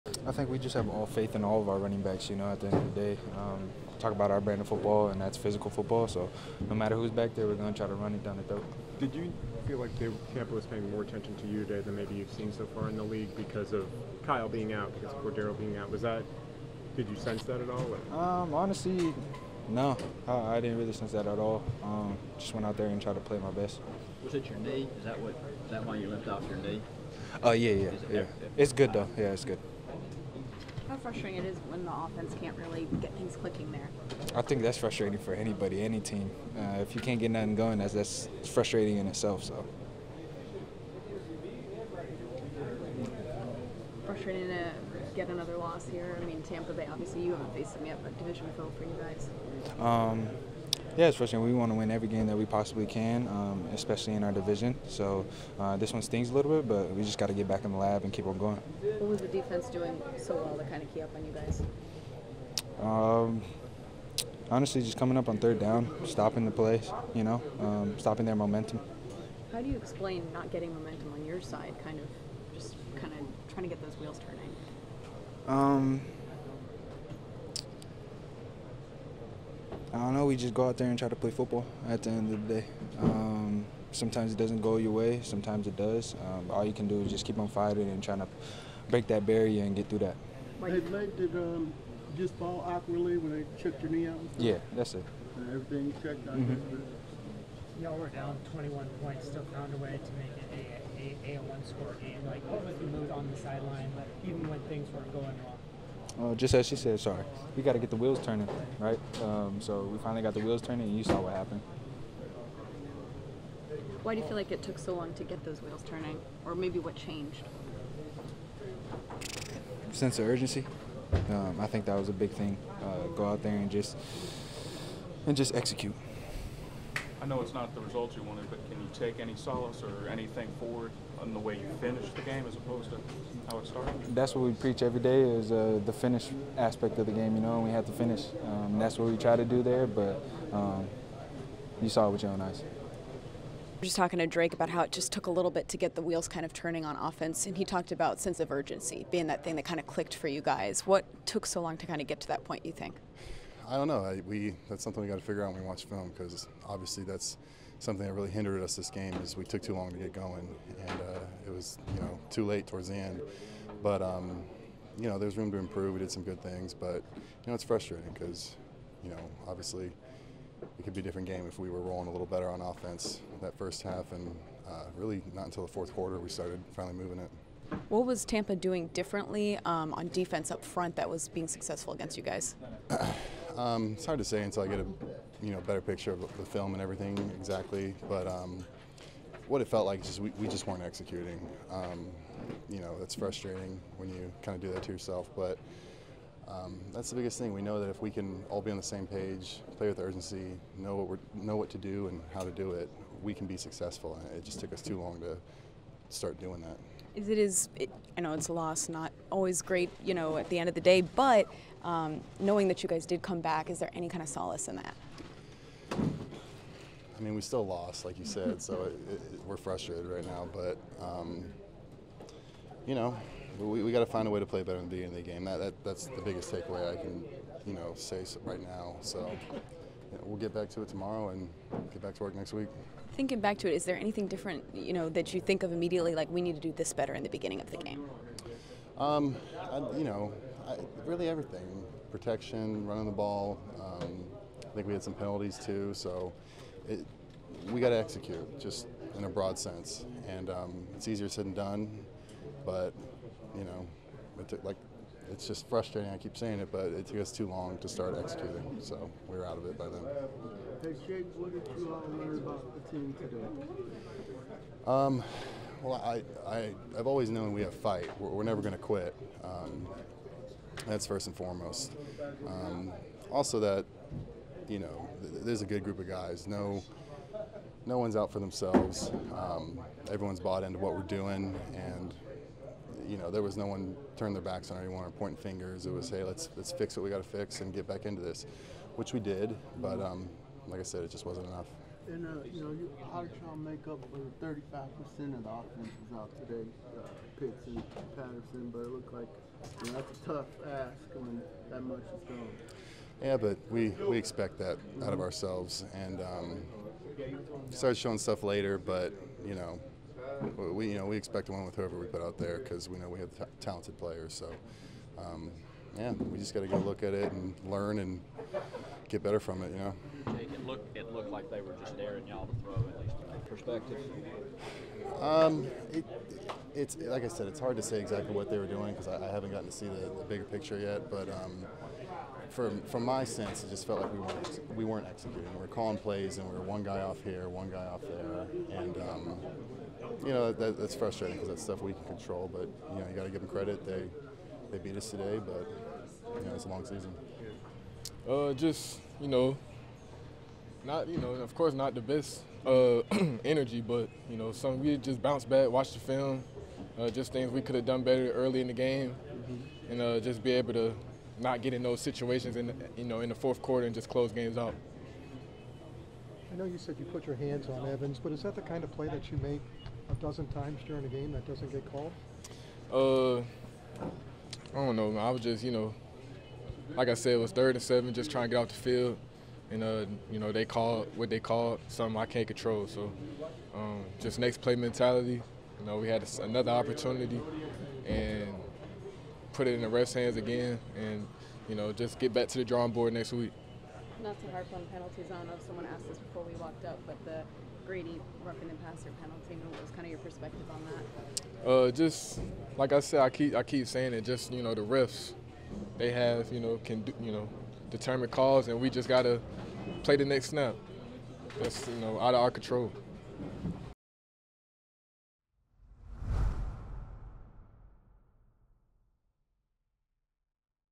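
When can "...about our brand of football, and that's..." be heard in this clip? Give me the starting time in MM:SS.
00:04.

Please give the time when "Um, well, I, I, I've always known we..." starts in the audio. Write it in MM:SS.
04:24.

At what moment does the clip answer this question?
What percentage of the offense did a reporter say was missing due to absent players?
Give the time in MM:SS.
04:54.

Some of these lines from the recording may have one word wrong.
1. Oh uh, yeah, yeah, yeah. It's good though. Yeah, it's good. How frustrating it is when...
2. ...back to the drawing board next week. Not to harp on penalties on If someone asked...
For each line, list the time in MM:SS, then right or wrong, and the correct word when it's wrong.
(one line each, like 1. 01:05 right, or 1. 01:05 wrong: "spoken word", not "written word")
1. 00:27 right
2. 06:32 right.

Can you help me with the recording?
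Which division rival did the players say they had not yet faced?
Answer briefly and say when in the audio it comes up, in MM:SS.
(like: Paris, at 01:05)
Tampa Bay, at 00:46.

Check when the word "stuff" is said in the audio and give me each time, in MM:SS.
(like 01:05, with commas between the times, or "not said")
05:08, 05:41.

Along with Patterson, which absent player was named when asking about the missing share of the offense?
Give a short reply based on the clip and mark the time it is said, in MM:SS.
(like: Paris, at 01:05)
Pitts, at 04:57.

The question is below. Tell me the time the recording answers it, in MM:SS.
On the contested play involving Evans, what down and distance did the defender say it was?
06:17.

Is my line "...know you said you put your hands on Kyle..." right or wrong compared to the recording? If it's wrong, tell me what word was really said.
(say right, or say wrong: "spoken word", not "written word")
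wrong: "Evans", not "Kyle".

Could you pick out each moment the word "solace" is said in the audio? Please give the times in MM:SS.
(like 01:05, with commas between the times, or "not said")
02:09, 03:34.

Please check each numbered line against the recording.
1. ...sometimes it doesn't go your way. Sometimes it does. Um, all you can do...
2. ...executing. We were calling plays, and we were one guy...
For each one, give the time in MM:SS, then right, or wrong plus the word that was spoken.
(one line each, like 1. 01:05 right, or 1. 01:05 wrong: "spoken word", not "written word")
1. 01:23 right
2. 05:35 right.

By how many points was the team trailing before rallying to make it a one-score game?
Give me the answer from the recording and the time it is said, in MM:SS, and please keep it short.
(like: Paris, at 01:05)
21, at 01:38.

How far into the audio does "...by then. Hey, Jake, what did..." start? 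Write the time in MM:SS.
04:19.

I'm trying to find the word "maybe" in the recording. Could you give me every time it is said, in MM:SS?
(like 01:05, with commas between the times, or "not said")
00:11, 01:56.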